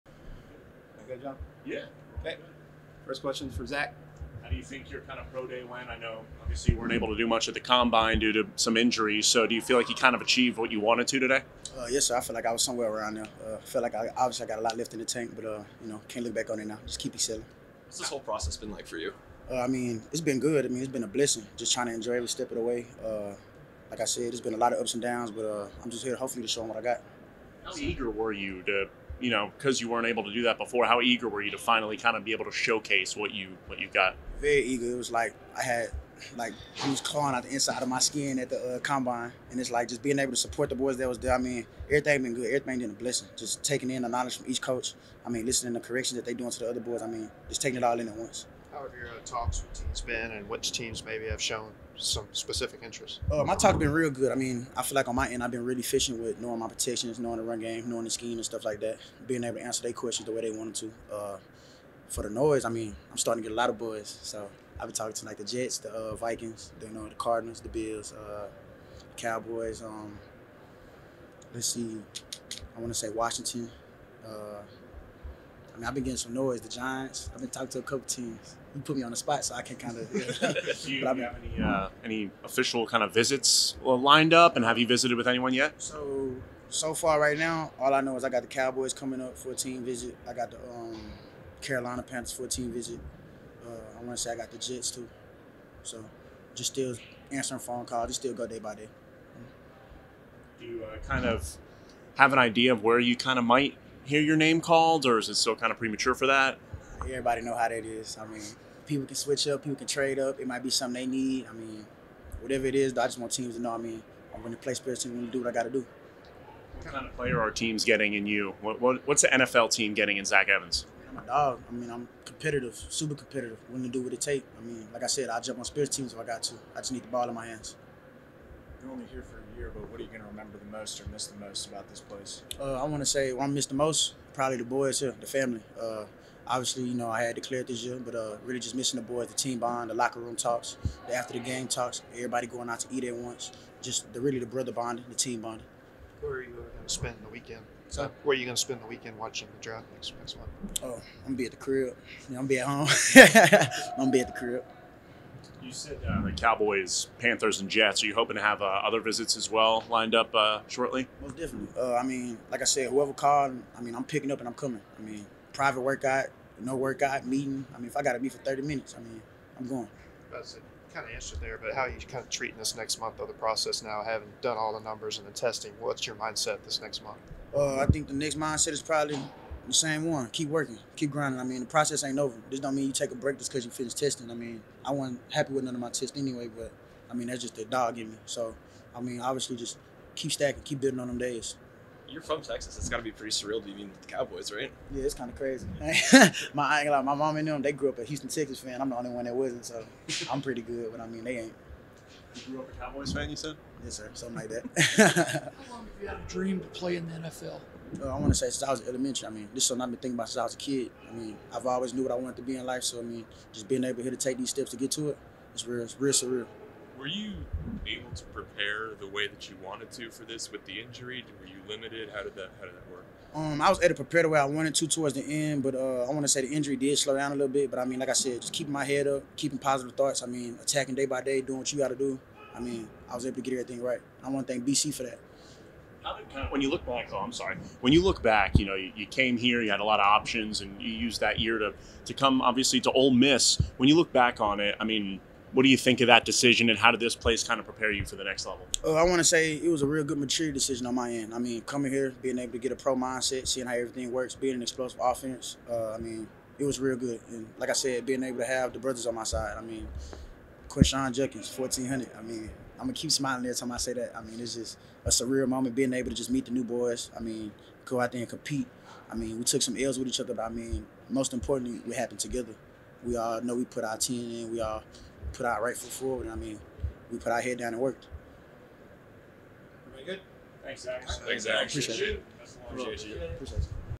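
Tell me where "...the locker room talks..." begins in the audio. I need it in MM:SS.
02:19.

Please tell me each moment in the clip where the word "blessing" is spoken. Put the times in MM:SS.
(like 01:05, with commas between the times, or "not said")
00:21, 00:42.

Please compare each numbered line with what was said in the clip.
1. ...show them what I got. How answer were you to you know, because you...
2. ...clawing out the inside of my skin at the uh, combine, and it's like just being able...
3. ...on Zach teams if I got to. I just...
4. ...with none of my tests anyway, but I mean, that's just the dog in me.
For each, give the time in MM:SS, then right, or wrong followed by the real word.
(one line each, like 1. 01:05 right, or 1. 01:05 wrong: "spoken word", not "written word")
1. 00:26 wrong: "eager", not "answer"
2. 00:37 right
3. 02:05 wrong: "Spirit", not "Zach"
4. 03:05 right.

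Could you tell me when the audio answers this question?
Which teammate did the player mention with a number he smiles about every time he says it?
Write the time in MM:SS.
04:20.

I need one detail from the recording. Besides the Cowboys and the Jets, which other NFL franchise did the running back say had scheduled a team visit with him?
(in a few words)
Carolina Panthers.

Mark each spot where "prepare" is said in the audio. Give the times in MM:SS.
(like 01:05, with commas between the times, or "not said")
03:38, 03:44, 04:07.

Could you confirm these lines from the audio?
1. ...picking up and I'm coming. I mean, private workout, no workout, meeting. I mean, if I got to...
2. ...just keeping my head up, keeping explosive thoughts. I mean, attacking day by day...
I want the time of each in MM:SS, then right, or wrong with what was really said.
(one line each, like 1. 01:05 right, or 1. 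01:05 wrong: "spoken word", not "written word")
1. 02:44 right
2. 03:48 wrong: "positive", not "explosive".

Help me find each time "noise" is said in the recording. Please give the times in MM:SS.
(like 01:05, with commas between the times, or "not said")
01:02, 01:16.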